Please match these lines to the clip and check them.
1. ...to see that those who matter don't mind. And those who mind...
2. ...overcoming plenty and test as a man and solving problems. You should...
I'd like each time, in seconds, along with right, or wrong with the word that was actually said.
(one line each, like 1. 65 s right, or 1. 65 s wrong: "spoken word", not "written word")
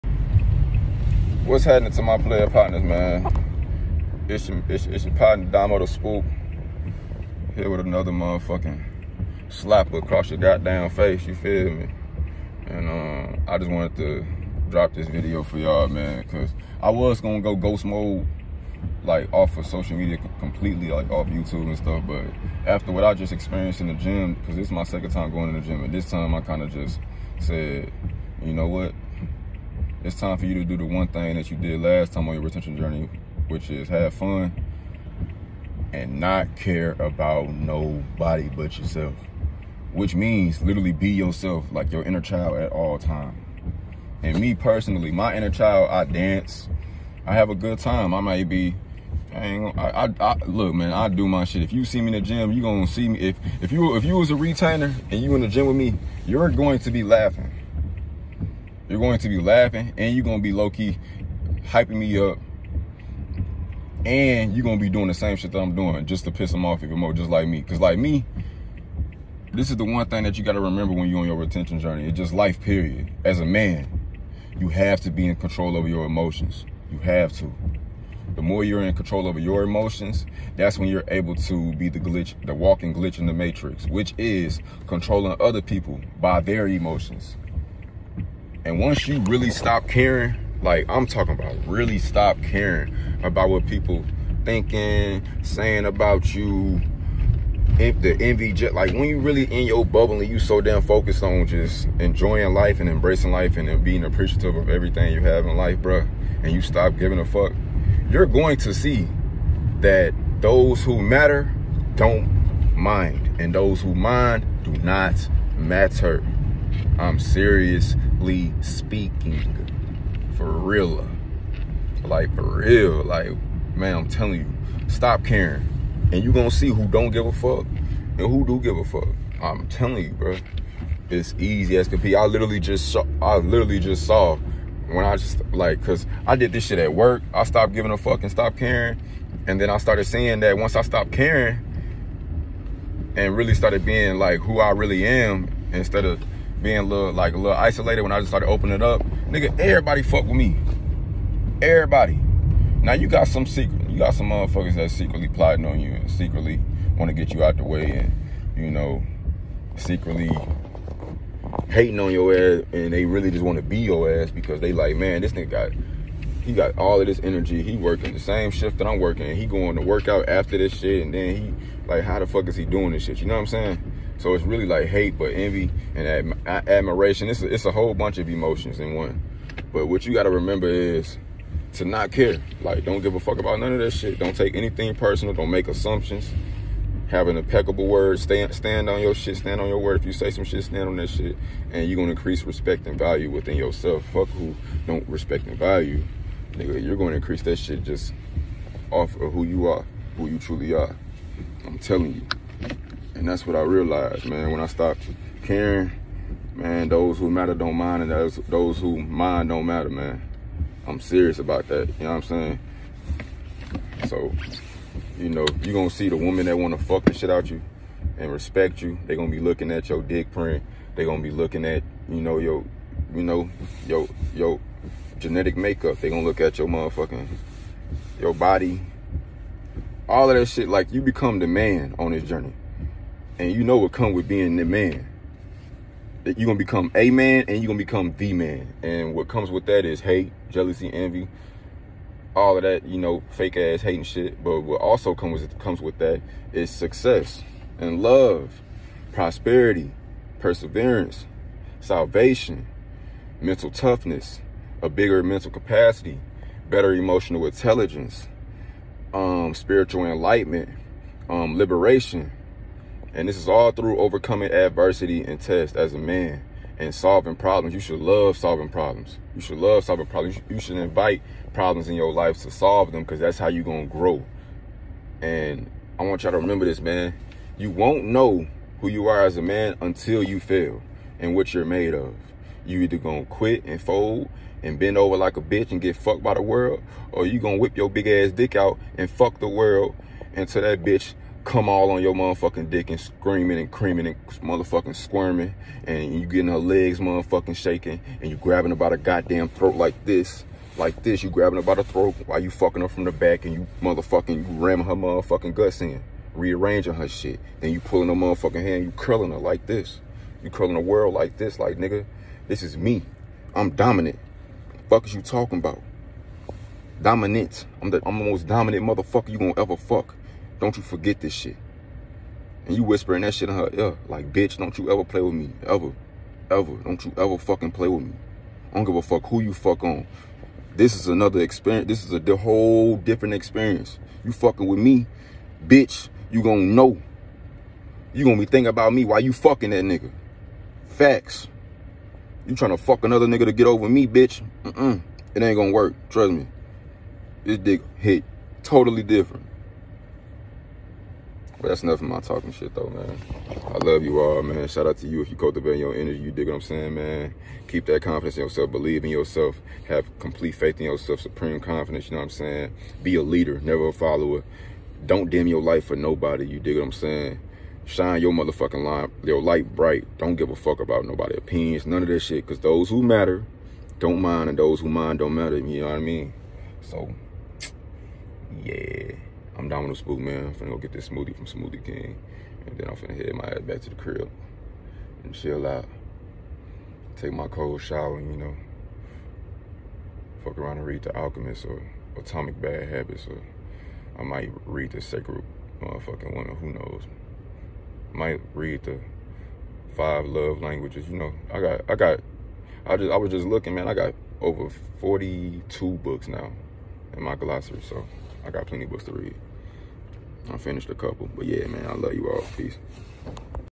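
1. 108 s right
2. 263 s wrong: "adversity", not "plenty".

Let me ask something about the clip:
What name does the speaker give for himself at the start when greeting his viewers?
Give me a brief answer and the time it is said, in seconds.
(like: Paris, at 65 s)
Damo the Spook, at 5 s.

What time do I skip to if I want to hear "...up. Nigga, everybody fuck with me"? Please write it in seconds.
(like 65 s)
148 s.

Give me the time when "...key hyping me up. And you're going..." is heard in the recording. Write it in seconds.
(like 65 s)
60 s.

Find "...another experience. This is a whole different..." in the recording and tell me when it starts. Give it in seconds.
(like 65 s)
331 s.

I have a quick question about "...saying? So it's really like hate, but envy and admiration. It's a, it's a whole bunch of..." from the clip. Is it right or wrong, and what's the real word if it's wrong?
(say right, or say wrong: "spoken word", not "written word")
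right.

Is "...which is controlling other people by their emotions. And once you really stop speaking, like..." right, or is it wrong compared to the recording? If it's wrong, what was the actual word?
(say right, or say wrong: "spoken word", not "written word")
wrong: "caring", not "speaking".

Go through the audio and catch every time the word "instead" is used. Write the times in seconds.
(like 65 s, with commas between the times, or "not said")
145 s.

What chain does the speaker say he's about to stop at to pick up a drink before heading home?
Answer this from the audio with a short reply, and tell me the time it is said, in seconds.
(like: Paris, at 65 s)
Smoothie King, at 381 s.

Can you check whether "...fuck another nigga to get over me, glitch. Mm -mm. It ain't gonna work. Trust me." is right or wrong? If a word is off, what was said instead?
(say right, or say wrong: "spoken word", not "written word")
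wrong: "bitch", not "glitch".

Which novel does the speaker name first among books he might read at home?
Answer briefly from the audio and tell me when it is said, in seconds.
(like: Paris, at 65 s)
The Alchemist, at 391 s.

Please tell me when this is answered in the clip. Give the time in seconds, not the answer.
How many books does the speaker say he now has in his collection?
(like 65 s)
404 s.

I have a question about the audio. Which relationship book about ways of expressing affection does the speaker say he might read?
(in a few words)
The Five Love Languages.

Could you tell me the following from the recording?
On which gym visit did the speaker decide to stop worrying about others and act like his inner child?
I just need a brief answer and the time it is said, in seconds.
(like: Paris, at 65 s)
Second, at 24 s.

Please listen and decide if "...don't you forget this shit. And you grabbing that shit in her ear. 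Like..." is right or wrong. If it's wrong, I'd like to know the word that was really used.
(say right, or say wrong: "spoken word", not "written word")
wrong: "whispering", not "grabbing".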